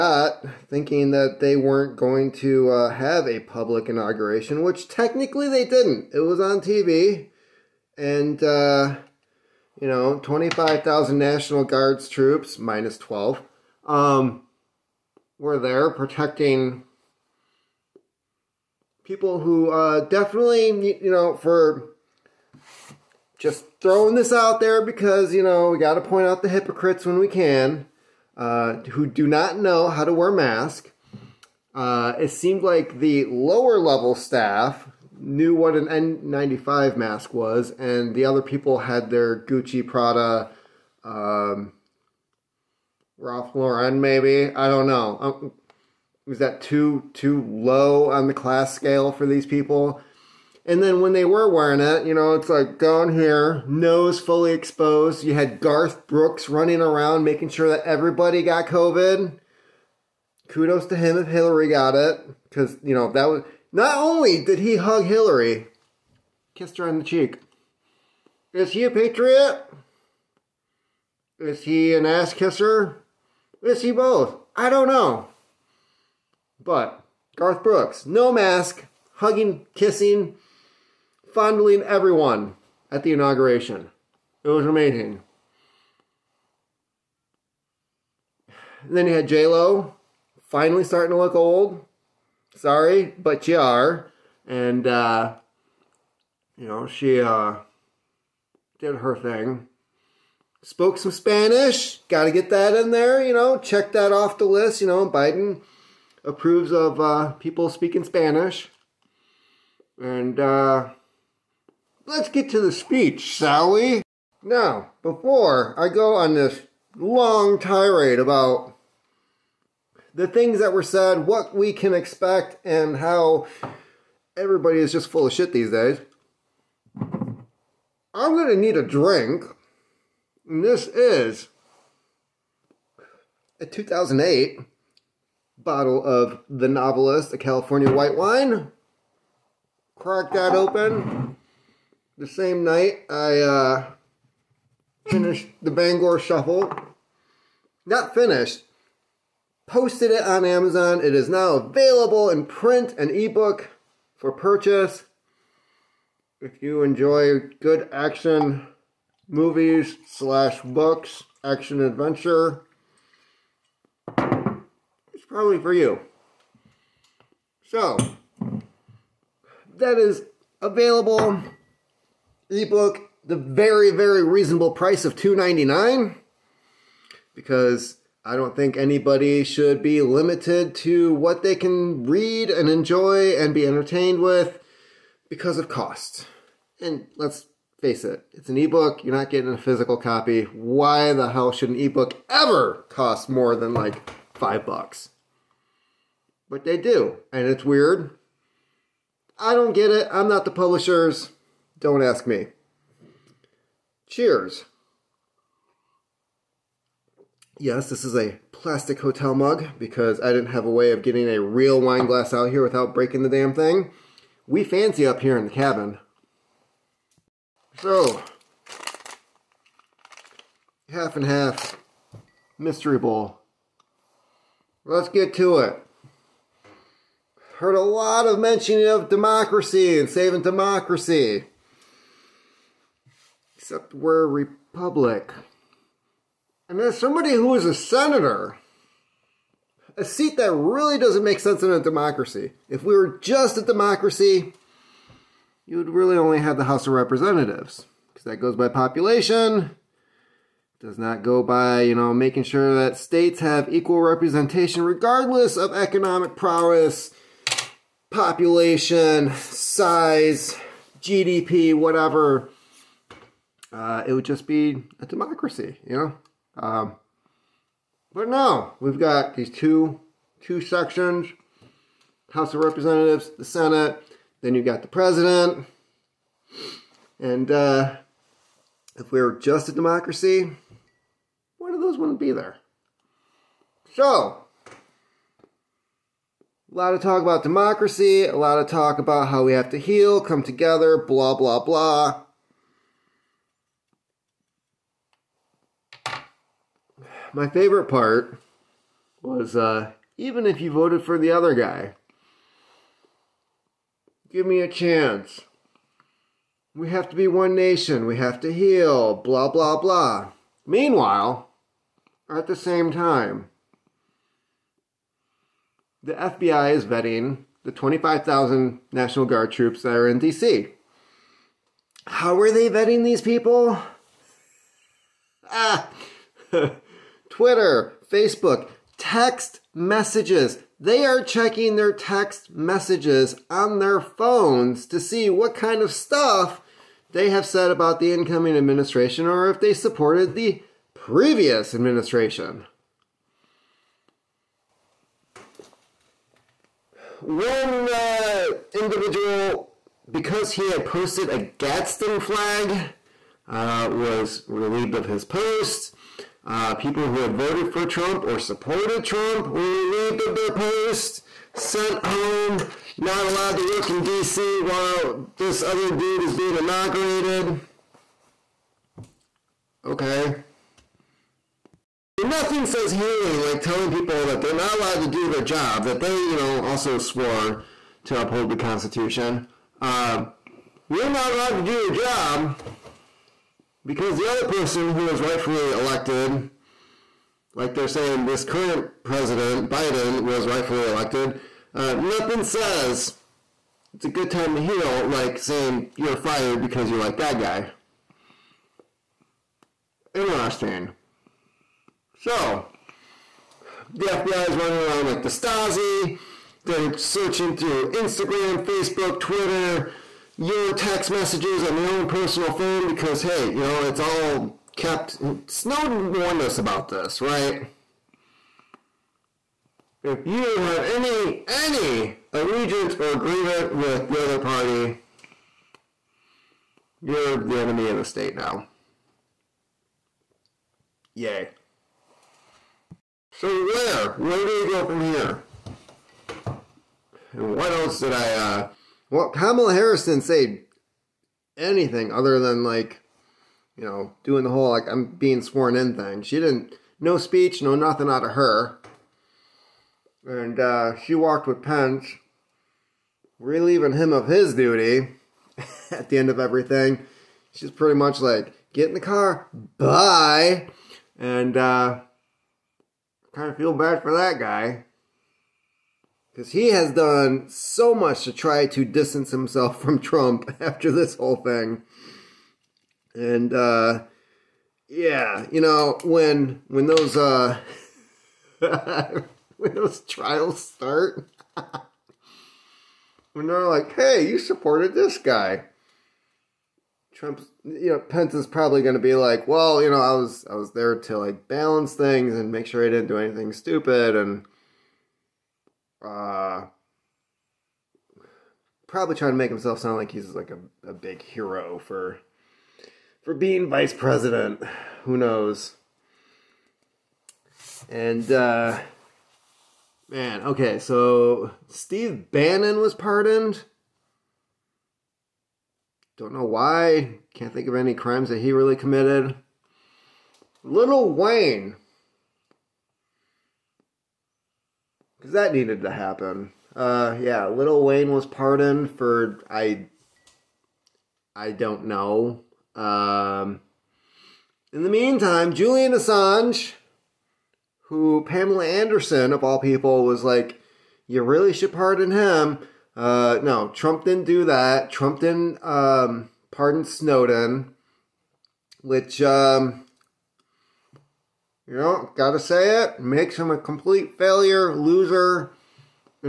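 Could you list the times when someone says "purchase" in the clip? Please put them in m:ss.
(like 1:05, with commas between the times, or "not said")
2:34.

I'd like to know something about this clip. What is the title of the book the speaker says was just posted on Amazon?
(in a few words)
The Bangor Shuffle.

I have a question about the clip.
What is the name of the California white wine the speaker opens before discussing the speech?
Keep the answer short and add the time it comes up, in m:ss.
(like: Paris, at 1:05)
The Novelist, at 2:16.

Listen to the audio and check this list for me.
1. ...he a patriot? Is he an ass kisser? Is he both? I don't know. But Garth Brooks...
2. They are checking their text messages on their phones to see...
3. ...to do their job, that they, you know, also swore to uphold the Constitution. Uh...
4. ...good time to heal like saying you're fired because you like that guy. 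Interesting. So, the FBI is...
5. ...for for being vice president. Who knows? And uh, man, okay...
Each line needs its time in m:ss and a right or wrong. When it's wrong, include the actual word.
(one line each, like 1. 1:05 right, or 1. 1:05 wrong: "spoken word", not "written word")
1. 1:08 right
2. 5:30 right
3. 6:15 right
4. 6:34 right
5. 8:21 right.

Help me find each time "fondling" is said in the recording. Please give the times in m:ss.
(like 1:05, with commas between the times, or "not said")
1:21.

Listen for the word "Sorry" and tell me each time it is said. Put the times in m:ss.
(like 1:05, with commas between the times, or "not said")
1:32.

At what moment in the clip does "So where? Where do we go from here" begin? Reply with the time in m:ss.
7:13.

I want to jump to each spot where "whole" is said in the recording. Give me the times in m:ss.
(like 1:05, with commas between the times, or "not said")
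7:24, 7:51.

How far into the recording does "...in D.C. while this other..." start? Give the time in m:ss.
6:03.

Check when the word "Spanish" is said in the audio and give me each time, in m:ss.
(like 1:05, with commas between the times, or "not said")
1:41, 1:48.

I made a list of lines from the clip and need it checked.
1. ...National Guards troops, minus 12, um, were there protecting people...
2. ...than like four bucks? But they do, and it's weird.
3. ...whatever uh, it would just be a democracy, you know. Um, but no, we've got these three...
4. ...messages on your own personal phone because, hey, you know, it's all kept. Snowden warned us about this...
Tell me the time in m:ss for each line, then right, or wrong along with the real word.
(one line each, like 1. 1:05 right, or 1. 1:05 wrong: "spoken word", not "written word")
1. 0:11 right
2. 3:13 wrong: "five", not "four"
3. 4:21 wrong: "two", not "three"
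4. 6:51 right.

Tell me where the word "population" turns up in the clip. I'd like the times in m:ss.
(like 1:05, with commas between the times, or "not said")
4:08, 4:18.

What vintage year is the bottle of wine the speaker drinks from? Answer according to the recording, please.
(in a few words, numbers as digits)
2008.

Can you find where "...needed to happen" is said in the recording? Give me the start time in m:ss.
8:45.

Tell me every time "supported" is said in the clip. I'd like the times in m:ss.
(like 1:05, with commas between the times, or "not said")
5:39, 5:58, 8:04.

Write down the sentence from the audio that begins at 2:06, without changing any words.
I'm going to need a drink.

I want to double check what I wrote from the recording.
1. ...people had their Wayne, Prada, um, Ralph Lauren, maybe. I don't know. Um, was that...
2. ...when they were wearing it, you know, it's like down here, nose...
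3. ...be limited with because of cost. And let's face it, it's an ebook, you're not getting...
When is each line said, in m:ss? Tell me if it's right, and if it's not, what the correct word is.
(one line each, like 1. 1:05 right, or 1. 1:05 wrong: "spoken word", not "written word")
1. 0:38 wrong: "Gucci", not "Wayne"
2. 0:50 right
3. 3:03 wrong: "entertained", not "limited".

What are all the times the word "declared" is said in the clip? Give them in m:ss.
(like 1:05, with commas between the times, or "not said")
not said.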